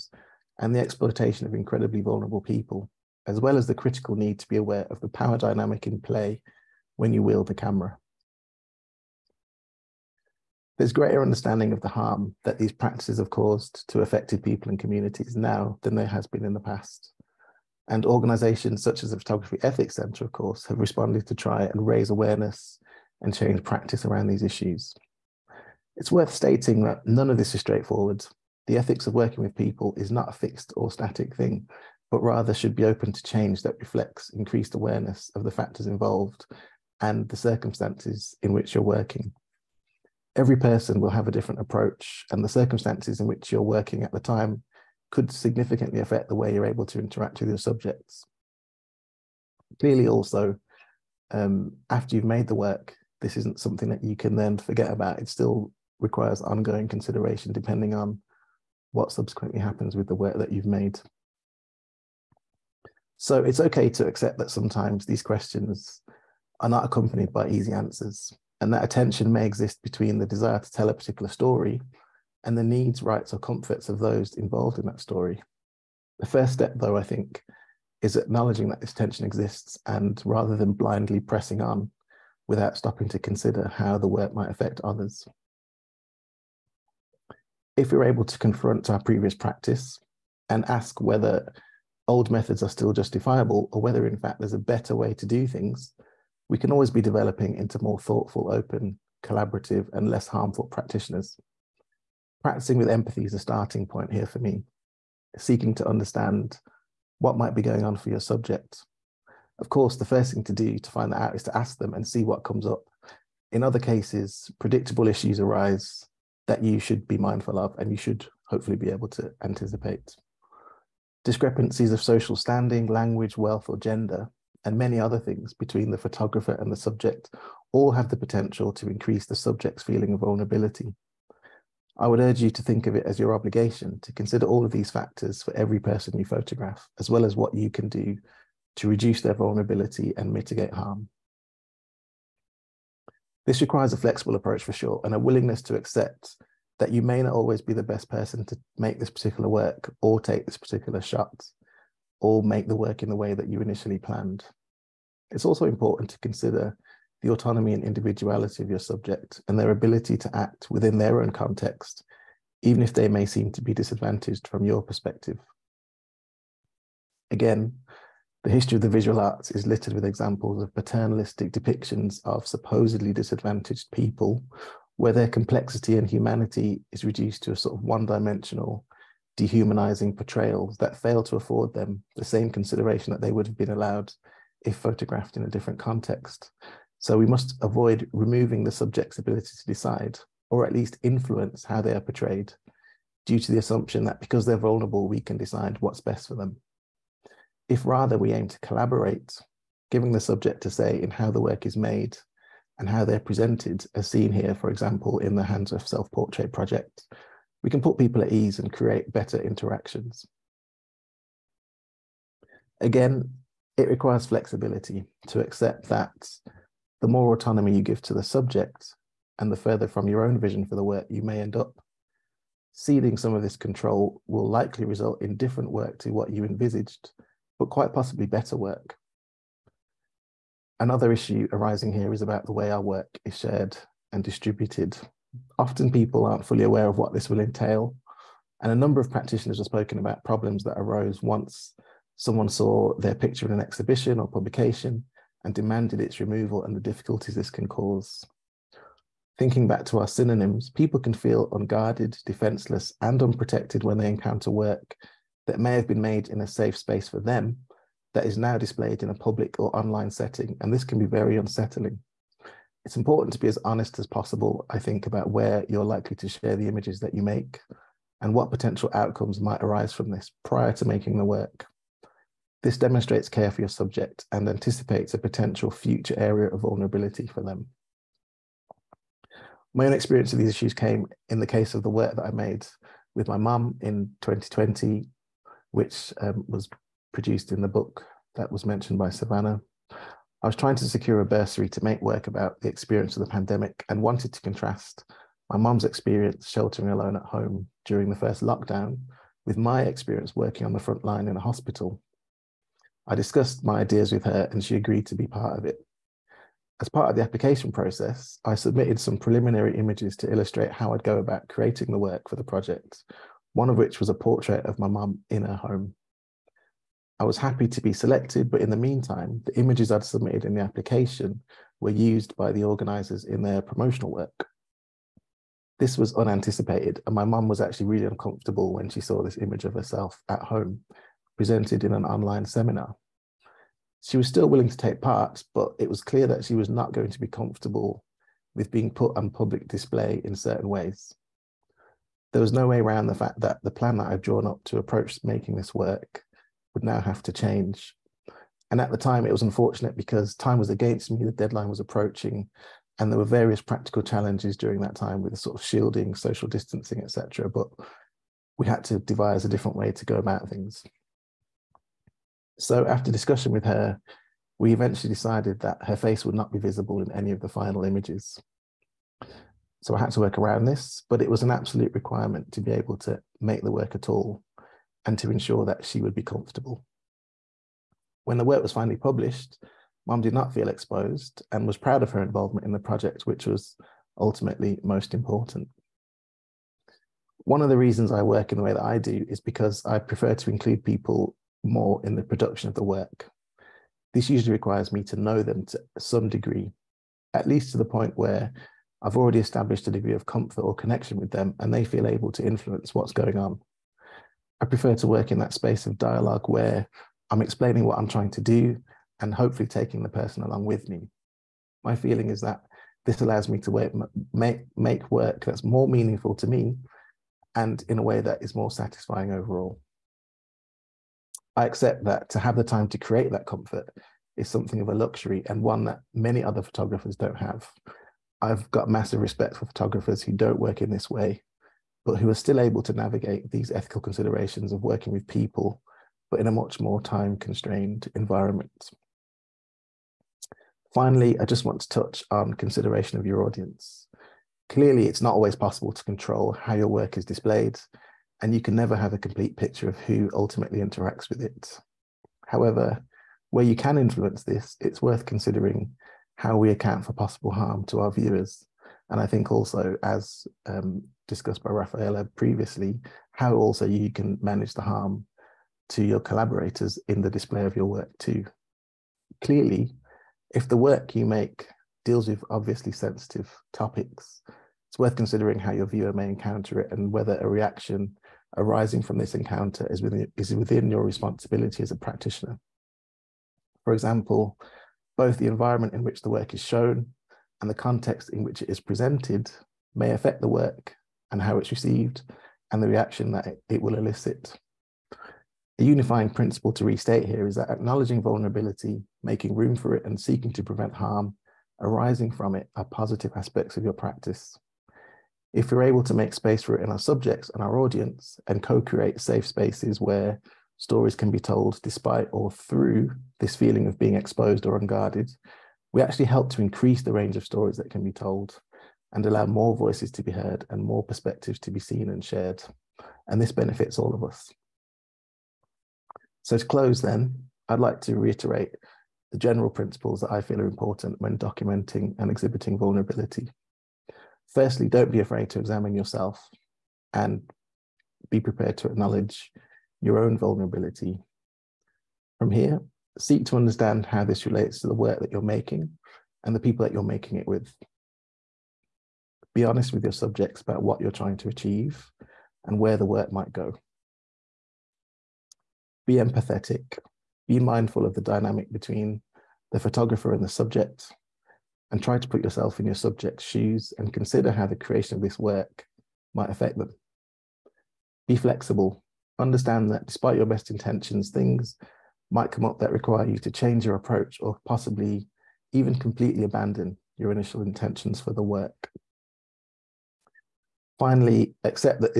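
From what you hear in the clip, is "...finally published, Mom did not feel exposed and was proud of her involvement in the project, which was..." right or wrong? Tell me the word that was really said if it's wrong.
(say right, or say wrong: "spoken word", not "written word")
right.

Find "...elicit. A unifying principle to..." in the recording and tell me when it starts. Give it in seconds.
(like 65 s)
493 s.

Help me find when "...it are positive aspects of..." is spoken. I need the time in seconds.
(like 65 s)
502 s.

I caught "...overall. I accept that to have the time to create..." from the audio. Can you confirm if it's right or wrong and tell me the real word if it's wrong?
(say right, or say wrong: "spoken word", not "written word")
right.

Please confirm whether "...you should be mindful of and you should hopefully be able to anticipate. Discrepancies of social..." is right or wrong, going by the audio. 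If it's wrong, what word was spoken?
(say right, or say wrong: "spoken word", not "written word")
right.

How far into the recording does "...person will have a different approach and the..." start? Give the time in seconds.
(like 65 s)
40 s.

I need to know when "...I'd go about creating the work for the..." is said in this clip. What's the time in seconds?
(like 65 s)
310 s.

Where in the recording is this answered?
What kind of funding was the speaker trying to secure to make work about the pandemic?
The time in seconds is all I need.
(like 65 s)
291 s.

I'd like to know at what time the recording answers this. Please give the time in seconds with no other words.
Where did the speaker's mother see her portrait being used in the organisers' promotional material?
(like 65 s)
332 s.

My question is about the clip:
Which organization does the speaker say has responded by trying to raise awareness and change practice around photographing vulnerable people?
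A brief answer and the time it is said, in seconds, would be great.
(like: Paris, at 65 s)
Photography Ethics Centre, at 19 s.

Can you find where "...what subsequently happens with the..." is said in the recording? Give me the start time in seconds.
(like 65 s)
58 s.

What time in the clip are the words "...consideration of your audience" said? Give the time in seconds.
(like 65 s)
442 s.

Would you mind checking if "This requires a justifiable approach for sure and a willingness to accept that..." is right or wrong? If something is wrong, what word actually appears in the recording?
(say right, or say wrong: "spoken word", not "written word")
wrong: "flexible", not "justifiable".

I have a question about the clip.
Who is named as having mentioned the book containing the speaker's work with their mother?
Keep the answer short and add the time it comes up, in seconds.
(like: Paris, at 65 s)
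Savannah, at 289 s.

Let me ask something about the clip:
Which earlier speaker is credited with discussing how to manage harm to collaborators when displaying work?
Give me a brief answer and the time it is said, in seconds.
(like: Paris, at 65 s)
Raphaela, at 461 s.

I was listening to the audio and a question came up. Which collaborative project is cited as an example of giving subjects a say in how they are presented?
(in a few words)
Hands of Self Portrait.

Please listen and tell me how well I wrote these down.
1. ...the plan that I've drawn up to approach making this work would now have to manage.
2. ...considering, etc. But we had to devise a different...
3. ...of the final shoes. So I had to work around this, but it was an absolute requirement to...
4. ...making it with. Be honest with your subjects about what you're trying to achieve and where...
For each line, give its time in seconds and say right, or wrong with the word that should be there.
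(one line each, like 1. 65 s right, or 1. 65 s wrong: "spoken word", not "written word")
1. 343 s wrong: "change", not "manage"
2. 356 s wrong: "distancing", not "considering"
3. 367 s wrong: "images", not "shoes"
4. 547 s right.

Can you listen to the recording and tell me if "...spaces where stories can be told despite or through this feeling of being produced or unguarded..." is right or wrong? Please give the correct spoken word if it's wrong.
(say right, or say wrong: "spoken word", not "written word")
wrong: "exposed", not "produced".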